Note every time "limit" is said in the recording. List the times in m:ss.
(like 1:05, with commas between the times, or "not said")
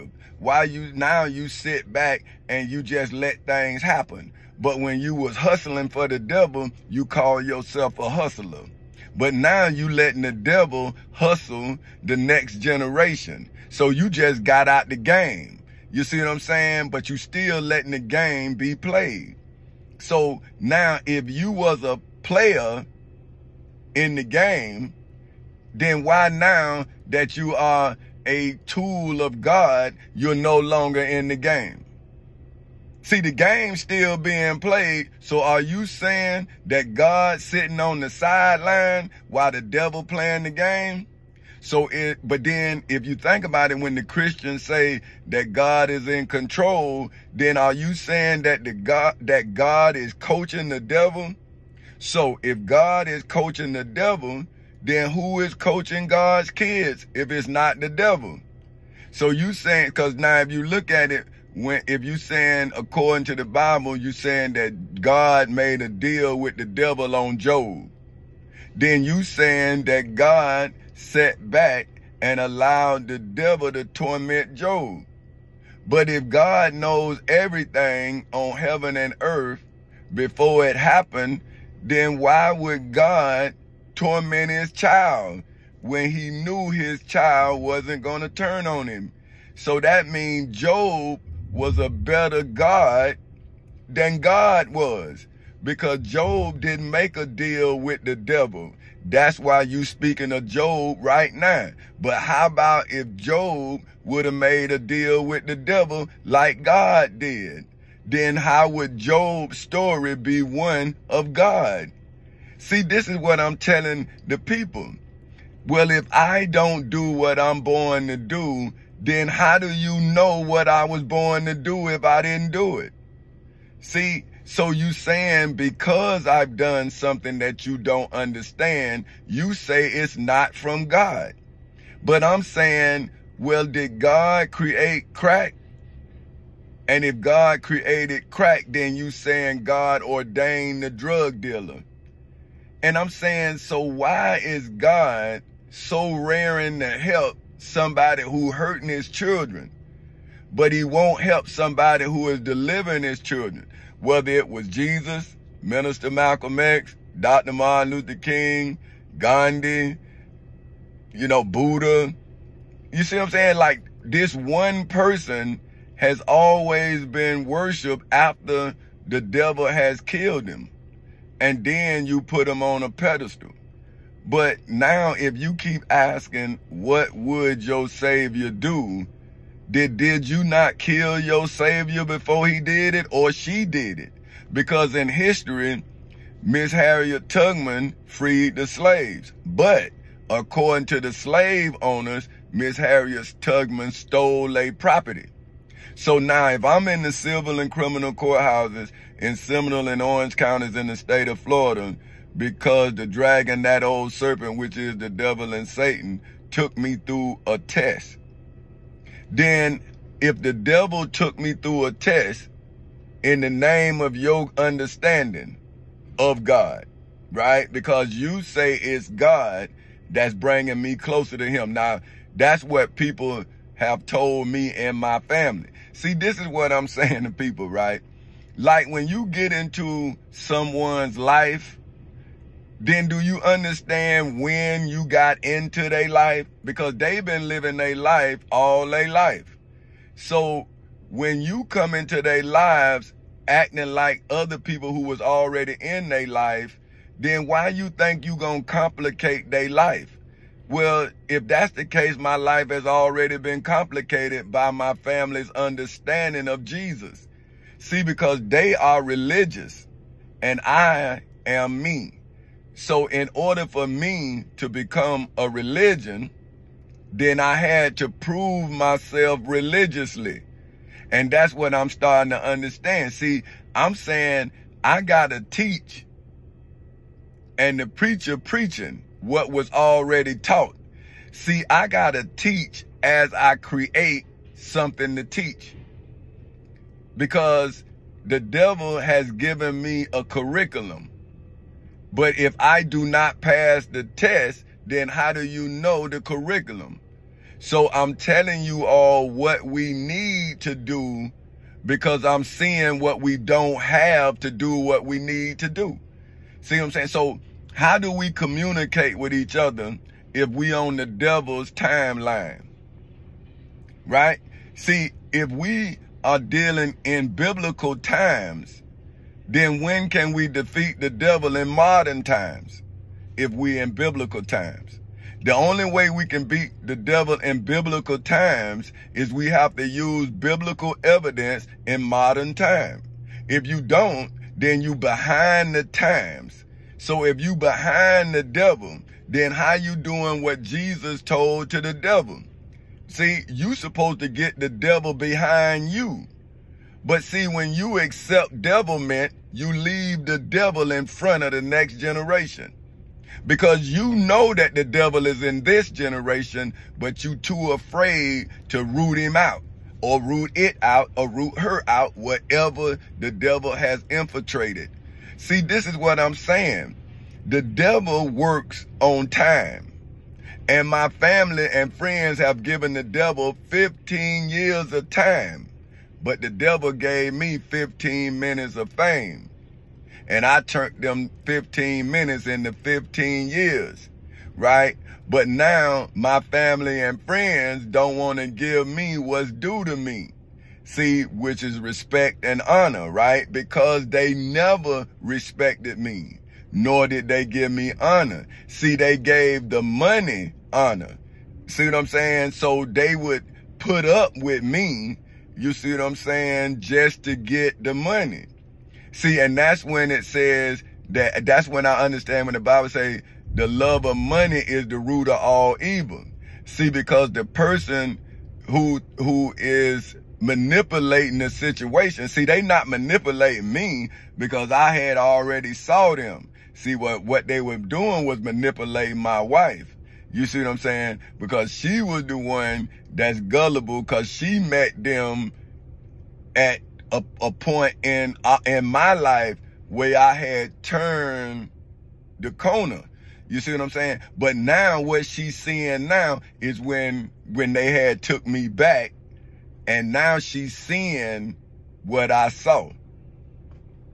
not said.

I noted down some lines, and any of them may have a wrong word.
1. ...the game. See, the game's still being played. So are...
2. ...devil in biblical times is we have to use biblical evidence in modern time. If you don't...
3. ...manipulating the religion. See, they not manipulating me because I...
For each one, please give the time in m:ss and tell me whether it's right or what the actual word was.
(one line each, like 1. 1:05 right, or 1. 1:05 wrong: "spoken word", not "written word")
1. 0:31 right
2. 5:26 right
3. 7:00 wrong: "situation", not "religion".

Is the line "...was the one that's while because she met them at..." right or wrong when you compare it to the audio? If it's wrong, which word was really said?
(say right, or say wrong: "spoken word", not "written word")
wrong: "gullible", not "while".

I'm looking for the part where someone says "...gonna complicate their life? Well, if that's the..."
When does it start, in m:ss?
4:08.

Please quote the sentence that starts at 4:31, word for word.
And that's what I'm starting to understand.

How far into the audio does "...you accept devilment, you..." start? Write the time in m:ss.
5:47.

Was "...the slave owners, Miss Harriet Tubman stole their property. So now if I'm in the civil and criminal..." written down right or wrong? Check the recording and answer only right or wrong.
right.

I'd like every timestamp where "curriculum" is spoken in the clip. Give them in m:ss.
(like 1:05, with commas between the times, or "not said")
4:50, 4:56.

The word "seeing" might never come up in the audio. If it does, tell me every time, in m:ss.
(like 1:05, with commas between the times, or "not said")
5:02, 7:25, 7:30.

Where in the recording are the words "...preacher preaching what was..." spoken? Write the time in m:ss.
4:37.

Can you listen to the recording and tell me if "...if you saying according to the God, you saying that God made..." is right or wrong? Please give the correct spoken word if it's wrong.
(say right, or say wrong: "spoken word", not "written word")
wrong: "Bible", not "God".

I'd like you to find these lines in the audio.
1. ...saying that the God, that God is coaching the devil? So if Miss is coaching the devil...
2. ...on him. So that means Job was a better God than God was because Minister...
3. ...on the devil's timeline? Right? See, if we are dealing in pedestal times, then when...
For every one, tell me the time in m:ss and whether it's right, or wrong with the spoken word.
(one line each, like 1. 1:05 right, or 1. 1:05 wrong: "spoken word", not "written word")
1. 0:47 wrong: "God", not "Miss"
2. 1:28 wrong: "Job", not "Minister"
3. 5:10 wrong: "biblical", not "pedestal".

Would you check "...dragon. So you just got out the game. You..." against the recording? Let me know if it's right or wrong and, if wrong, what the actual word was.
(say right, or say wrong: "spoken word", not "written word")
wrong: "generation", not "dragon".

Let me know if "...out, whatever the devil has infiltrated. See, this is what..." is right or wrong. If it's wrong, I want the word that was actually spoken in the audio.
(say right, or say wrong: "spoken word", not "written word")
right.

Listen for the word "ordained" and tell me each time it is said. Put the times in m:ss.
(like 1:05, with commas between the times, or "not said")
2:20.